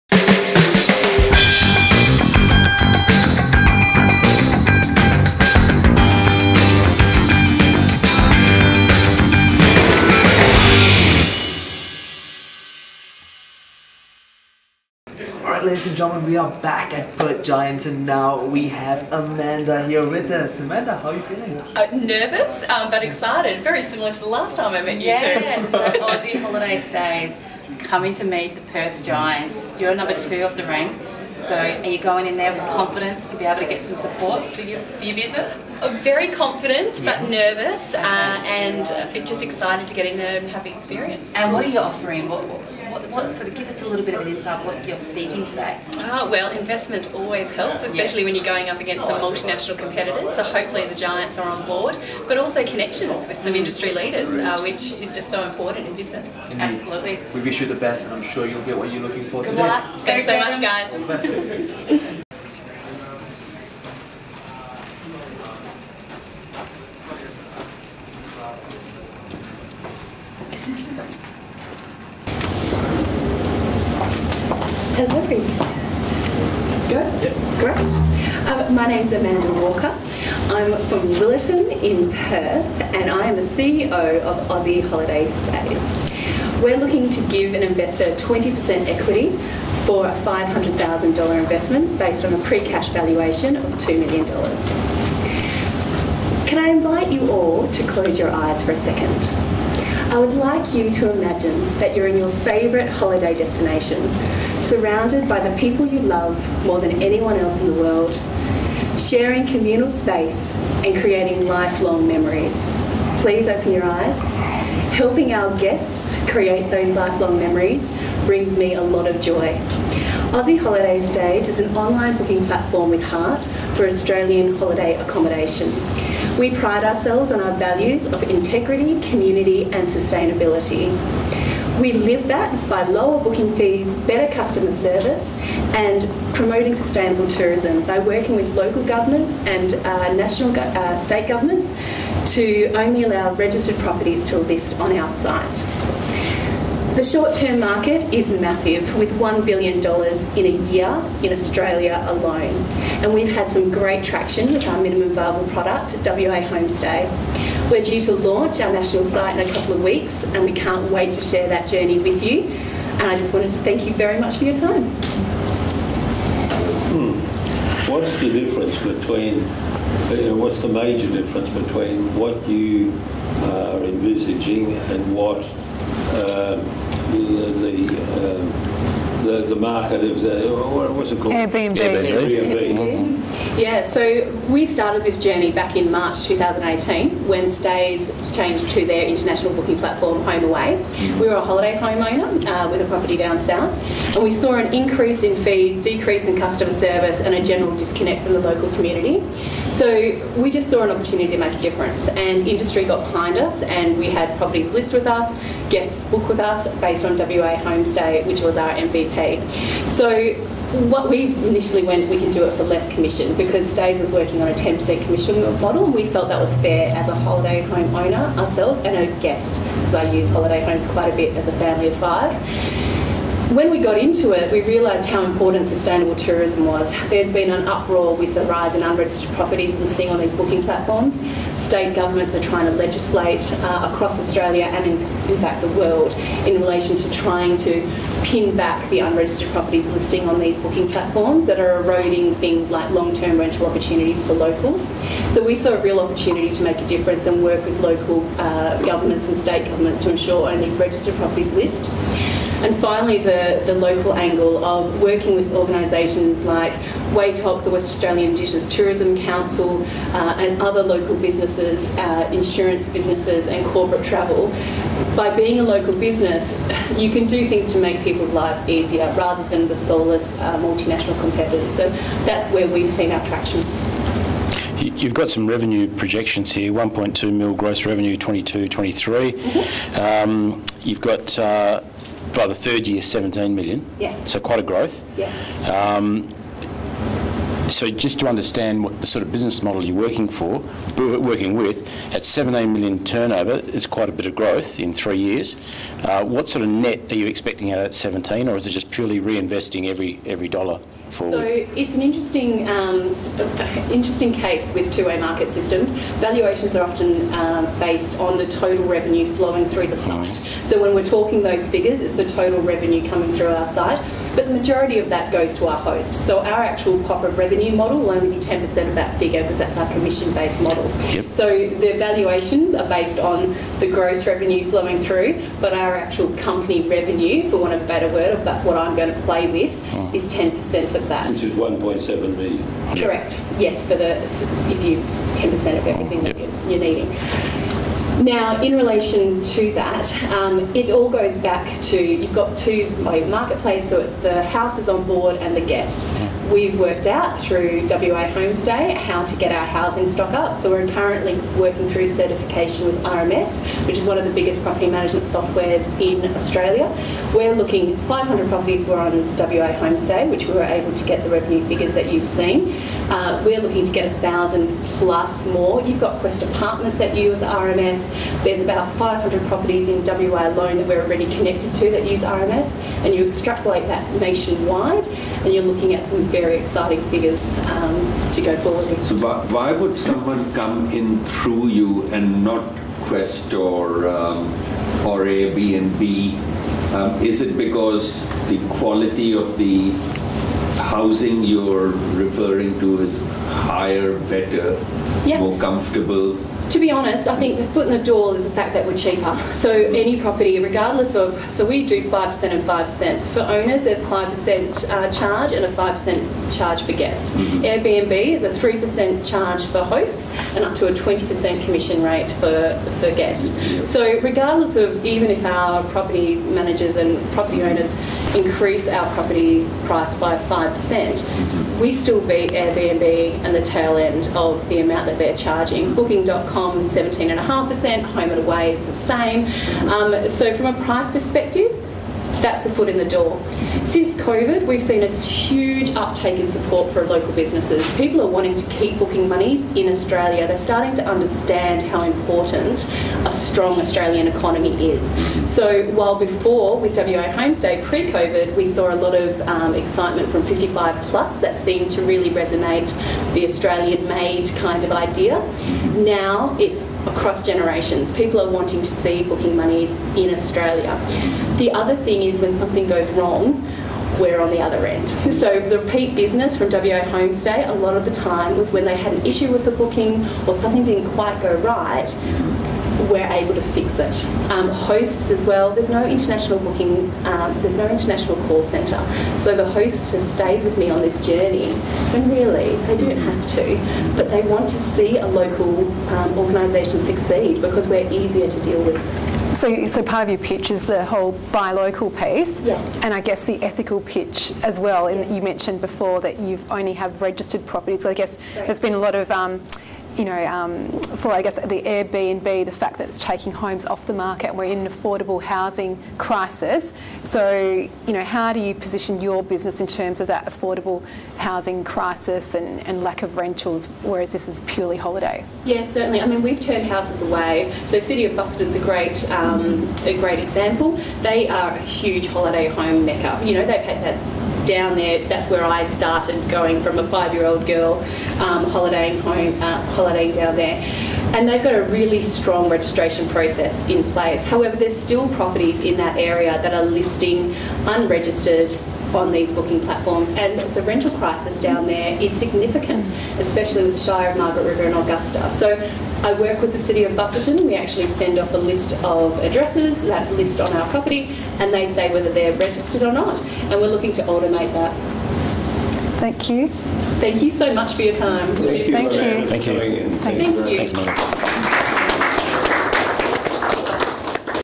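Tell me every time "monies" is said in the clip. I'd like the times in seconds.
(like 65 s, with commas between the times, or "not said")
439 s, 459 s.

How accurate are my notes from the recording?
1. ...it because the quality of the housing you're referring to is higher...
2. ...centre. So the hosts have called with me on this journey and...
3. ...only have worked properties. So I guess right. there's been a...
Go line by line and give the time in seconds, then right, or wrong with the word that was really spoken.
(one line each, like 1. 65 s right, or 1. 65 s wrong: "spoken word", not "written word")
1. 387 s right
2. 478 s wrong: "stayed", not "called"
3. 496 s wrong: "registered", not "worked".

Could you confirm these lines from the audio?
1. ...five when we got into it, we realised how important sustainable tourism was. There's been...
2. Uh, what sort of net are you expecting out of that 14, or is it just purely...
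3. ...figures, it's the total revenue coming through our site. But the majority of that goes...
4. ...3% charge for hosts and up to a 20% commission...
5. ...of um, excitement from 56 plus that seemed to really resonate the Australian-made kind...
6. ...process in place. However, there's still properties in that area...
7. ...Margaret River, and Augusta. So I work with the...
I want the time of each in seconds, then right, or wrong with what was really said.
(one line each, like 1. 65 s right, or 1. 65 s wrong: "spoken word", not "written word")
1. 221 s right
2. 296 s wrong: "17", not "14"
3. 311 s right
4. 408 s right
5. 449 s wrong: "55", not "56"
6. 533 s right
7. 544 s right.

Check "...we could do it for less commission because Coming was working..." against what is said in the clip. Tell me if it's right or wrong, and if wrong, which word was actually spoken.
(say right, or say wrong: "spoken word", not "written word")
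wrong: "Stayz", not "Coming".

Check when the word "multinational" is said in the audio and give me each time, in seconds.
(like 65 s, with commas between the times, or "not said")
49 s, 270 s.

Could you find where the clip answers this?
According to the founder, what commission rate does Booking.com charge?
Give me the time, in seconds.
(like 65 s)
426 s.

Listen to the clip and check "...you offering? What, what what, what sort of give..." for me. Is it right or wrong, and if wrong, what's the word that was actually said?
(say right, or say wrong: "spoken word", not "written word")
right.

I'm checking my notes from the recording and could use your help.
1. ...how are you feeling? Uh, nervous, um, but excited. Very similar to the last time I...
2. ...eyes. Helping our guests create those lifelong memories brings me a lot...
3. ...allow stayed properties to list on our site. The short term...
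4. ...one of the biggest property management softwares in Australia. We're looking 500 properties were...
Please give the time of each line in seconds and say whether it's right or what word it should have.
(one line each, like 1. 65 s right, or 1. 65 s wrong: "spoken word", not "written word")
1. 20 s right
2. 113 s right
3. 143 s wrong: "registered", not "stayed"
4. 354 s right.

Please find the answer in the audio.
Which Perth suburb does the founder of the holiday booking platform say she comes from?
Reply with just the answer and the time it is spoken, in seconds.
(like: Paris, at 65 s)
Willetton, at 81 s.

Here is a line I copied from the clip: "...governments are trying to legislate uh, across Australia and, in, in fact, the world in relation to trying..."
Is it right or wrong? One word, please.
right.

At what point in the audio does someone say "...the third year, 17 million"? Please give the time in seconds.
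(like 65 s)
282 s.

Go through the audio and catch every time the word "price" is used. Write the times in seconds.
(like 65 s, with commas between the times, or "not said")
419 s, 430 s.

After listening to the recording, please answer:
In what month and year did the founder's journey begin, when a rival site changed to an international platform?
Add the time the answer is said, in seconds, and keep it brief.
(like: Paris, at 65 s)
March 2018, at 185 s.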